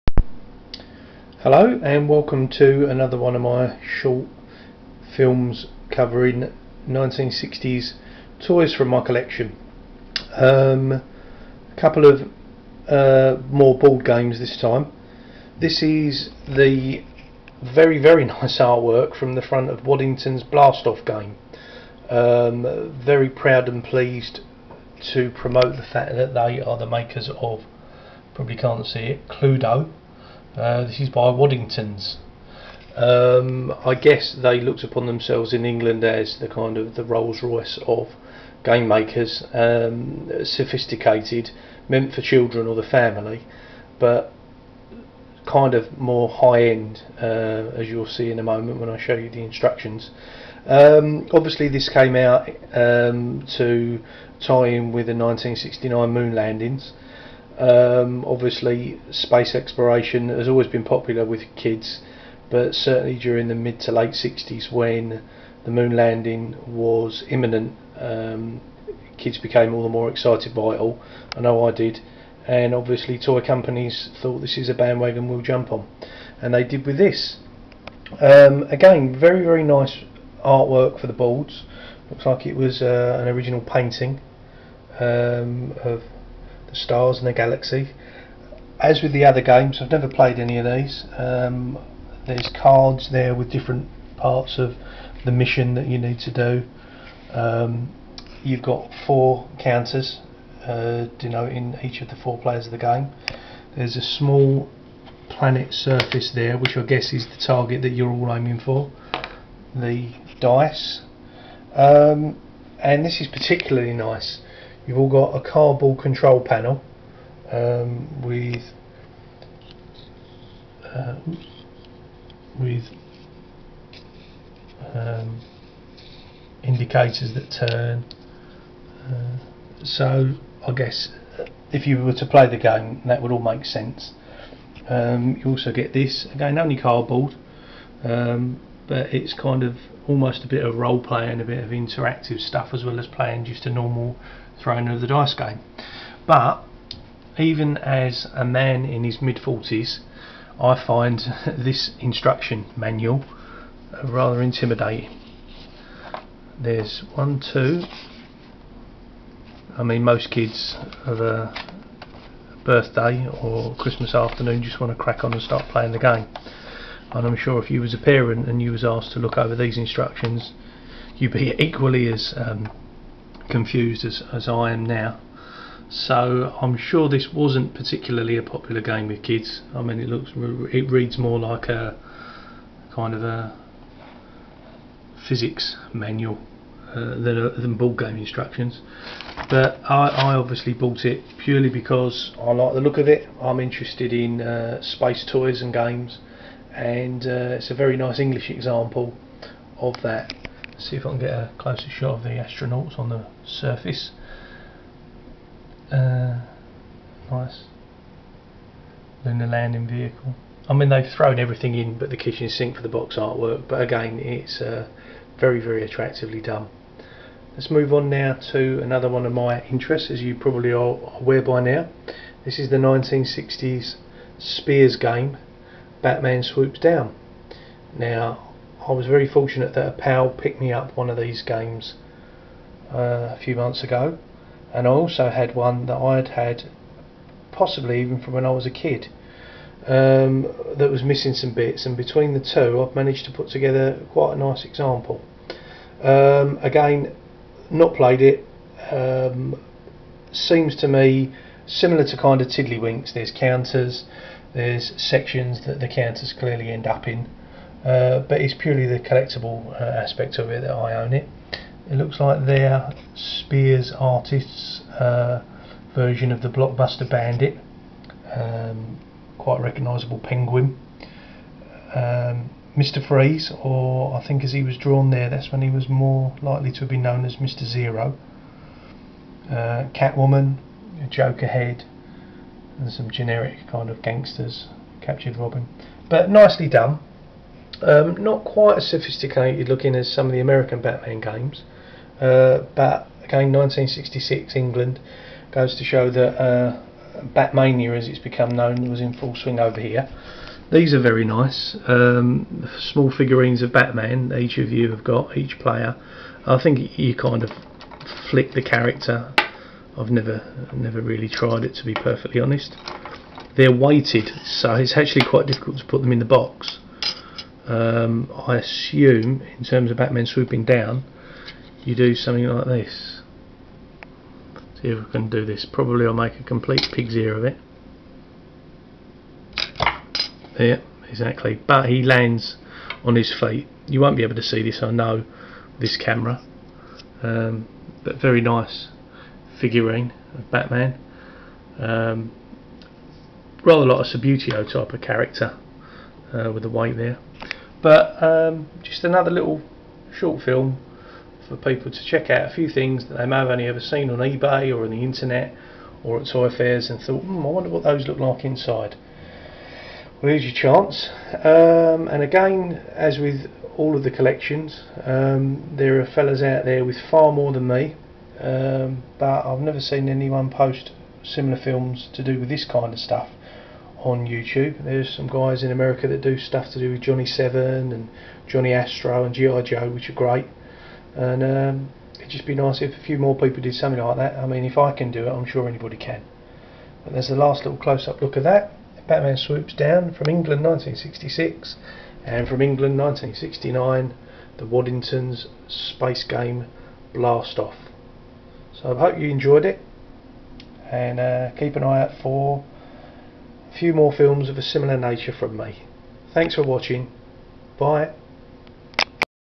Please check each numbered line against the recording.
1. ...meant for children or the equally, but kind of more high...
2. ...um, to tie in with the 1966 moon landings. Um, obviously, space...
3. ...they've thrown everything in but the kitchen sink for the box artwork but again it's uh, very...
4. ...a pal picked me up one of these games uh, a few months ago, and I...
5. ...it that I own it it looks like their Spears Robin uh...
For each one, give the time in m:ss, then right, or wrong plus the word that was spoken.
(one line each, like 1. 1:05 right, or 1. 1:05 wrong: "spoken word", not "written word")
1. 0:41 wrong: "family", not "equally"
2. 0:52 wrong: "1969", not "1966"
3. 3:30 right
4. 3:49 right
5. 4:20 wrong: "Artists", not "Robin".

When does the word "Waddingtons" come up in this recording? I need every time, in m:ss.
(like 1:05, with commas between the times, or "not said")
0:19, 0:31, 6:34.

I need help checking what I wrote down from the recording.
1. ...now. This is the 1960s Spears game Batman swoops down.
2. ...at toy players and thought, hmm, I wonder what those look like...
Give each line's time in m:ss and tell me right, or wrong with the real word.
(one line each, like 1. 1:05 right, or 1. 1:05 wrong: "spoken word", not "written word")
1. 3:41 right
2. 5:56 wrong: "fairs", not "players".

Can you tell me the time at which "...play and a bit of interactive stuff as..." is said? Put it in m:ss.
2:21.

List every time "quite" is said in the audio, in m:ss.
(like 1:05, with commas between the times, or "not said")
4:04, 4:29, 4:48, 5:15.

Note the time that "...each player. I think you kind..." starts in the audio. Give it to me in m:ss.
5:05.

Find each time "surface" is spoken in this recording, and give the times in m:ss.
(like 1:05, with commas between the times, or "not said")
1:45, 3:23.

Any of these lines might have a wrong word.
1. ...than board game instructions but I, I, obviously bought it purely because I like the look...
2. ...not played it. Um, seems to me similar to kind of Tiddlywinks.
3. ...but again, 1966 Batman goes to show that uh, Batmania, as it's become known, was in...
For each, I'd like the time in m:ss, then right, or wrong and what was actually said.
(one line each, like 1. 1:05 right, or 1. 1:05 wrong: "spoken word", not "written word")
1. 3:07 right
2. 4:07 right
3. 4:52 wrong: "England", not "Batman".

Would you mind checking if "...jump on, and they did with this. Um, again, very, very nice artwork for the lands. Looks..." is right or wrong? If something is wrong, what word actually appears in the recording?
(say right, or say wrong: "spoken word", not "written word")
wrong: "boards", not "lands".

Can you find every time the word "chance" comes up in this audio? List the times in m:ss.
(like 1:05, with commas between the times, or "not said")
6:00.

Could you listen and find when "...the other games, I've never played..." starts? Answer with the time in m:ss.
1:29.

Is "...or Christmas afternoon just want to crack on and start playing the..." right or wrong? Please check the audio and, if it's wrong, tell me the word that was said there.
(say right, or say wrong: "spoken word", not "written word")
right.